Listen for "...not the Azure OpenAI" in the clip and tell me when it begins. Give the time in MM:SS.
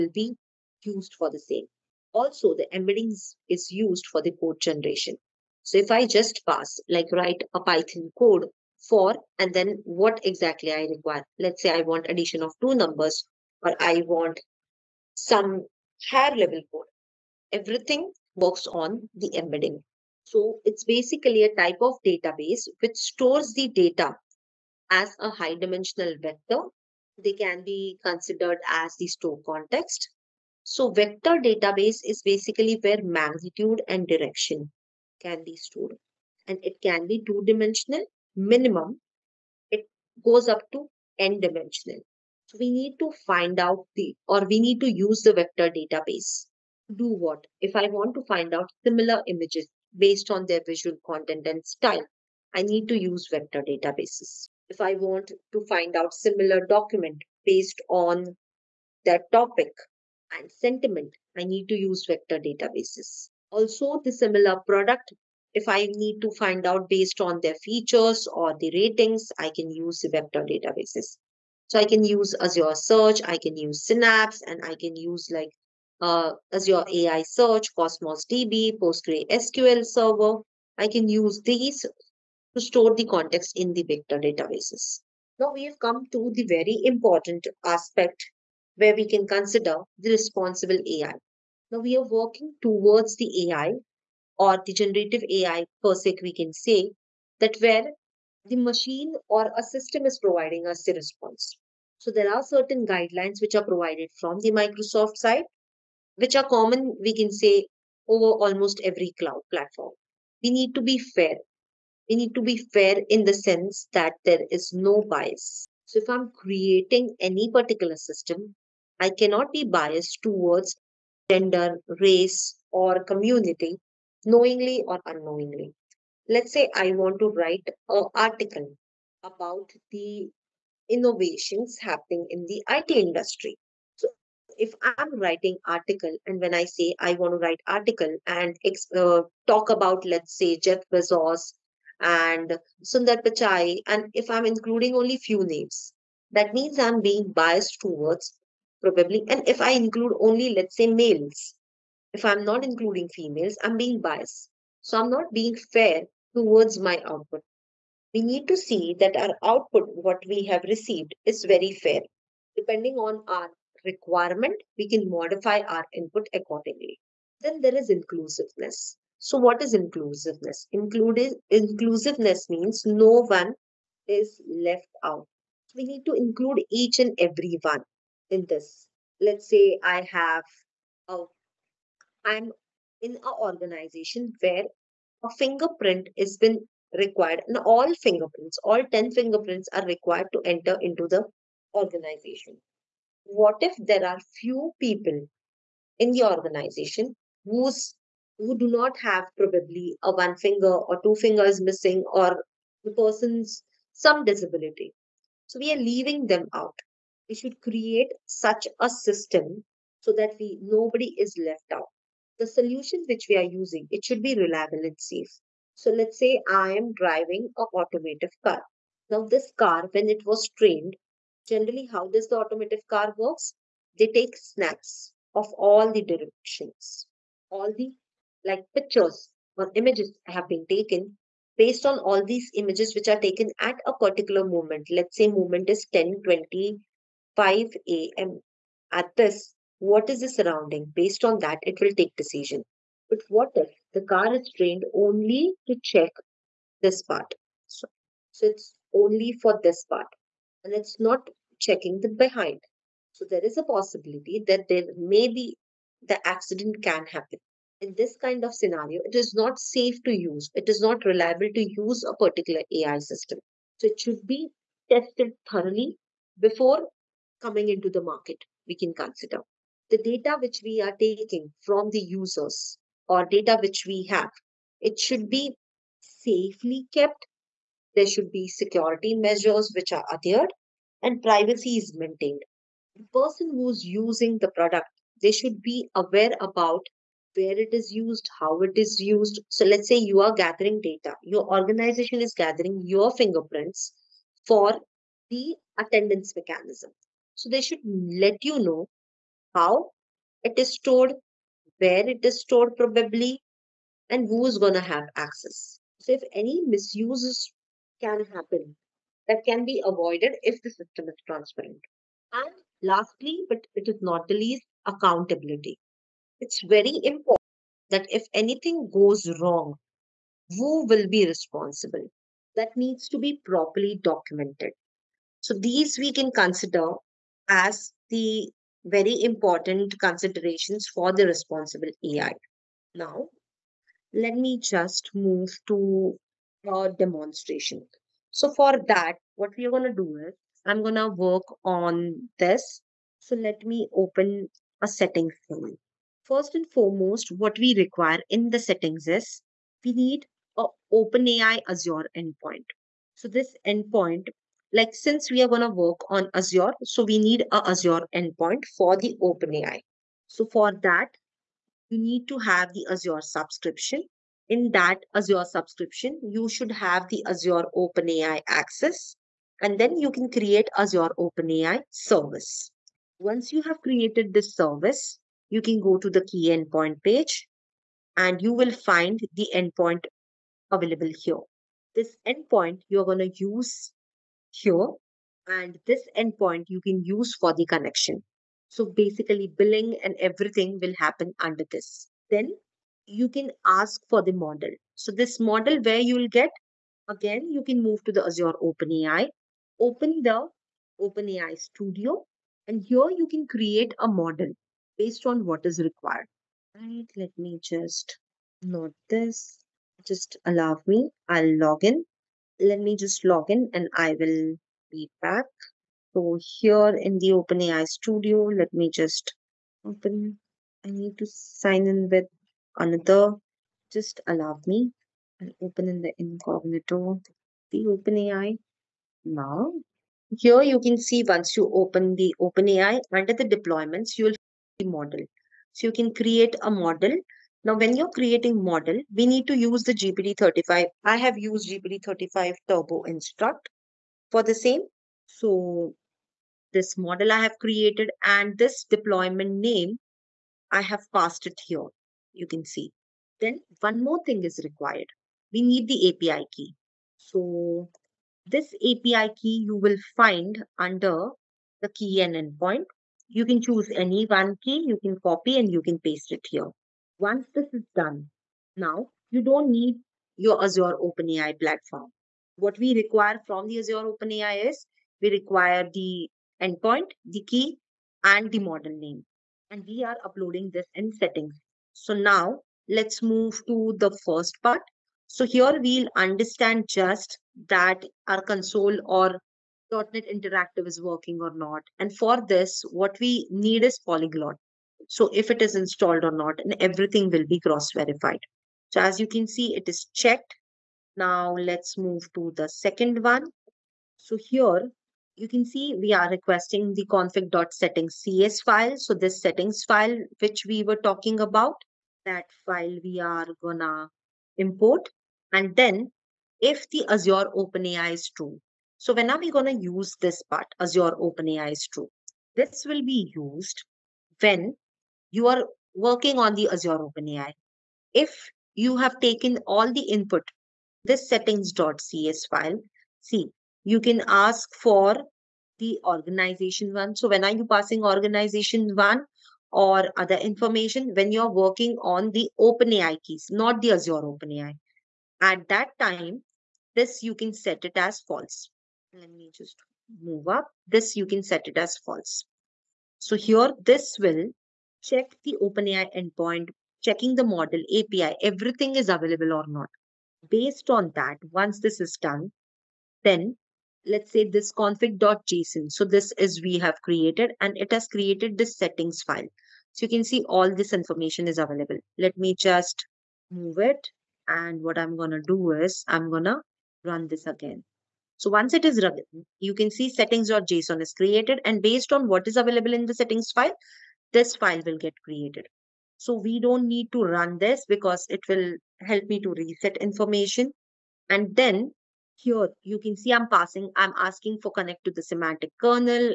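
09:03.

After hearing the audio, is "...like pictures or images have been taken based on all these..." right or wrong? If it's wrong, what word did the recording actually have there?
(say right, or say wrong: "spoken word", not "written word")
right.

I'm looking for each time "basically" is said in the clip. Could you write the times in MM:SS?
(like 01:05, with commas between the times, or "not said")
00:20, 00:32, 06:28.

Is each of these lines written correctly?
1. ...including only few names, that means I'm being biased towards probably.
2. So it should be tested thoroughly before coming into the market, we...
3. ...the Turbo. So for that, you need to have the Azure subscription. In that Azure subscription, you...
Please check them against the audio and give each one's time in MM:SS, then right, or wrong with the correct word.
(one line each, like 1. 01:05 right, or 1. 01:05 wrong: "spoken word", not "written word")
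1. 02:24 right
2. 04:23 right
3. 05:58 wrong: "OpenAI", not "Turbo".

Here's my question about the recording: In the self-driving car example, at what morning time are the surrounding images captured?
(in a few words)
10:25 a.m.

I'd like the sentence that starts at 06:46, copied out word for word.
Right, let me just note this.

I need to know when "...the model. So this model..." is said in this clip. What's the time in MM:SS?
06:34.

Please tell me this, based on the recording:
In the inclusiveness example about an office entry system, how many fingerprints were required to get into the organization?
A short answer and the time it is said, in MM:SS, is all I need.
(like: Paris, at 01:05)
10, at 03:08.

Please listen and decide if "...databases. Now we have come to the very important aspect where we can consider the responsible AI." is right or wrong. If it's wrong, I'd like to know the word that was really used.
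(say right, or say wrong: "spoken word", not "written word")
right.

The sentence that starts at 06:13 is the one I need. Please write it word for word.
Once you have created this service, you can go to the key endpoint page and you will find the endpoint available here.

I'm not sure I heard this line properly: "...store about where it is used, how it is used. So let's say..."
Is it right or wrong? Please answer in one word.
wrong.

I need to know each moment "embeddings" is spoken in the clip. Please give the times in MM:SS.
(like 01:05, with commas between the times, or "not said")
00:02, 00:19.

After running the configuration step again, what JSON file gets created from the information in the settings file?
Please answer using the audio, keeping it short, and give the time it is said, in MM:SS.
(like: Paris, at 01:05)
settings.json, at 09:40.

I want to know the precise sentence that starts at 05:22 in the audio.
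That needs to be properly documented.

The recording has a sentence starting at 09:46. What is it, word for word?
So we don't need to run this because it will help me to reset information.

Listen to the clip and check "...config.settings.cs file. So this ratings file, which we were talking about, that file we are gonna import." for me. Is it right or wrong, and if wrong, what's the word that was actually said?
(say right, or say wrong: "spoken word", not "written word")
wrong: "settings", not "ratings".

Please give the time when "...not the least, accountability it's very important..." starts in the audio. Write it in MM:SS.
05:14.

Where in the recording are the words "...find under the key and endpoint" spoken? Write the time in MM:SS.
07:40.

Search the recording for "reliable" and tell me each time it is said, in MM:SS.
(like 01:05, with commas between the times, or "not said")
03:34, 04:21.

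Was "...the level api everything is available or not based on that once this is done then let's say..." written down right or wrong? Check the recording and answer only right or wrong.
wrong.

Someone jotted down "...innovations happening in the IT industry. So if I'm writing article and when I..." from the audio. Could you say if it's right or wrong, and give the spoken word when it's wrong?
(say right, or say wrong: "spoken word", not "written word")
right.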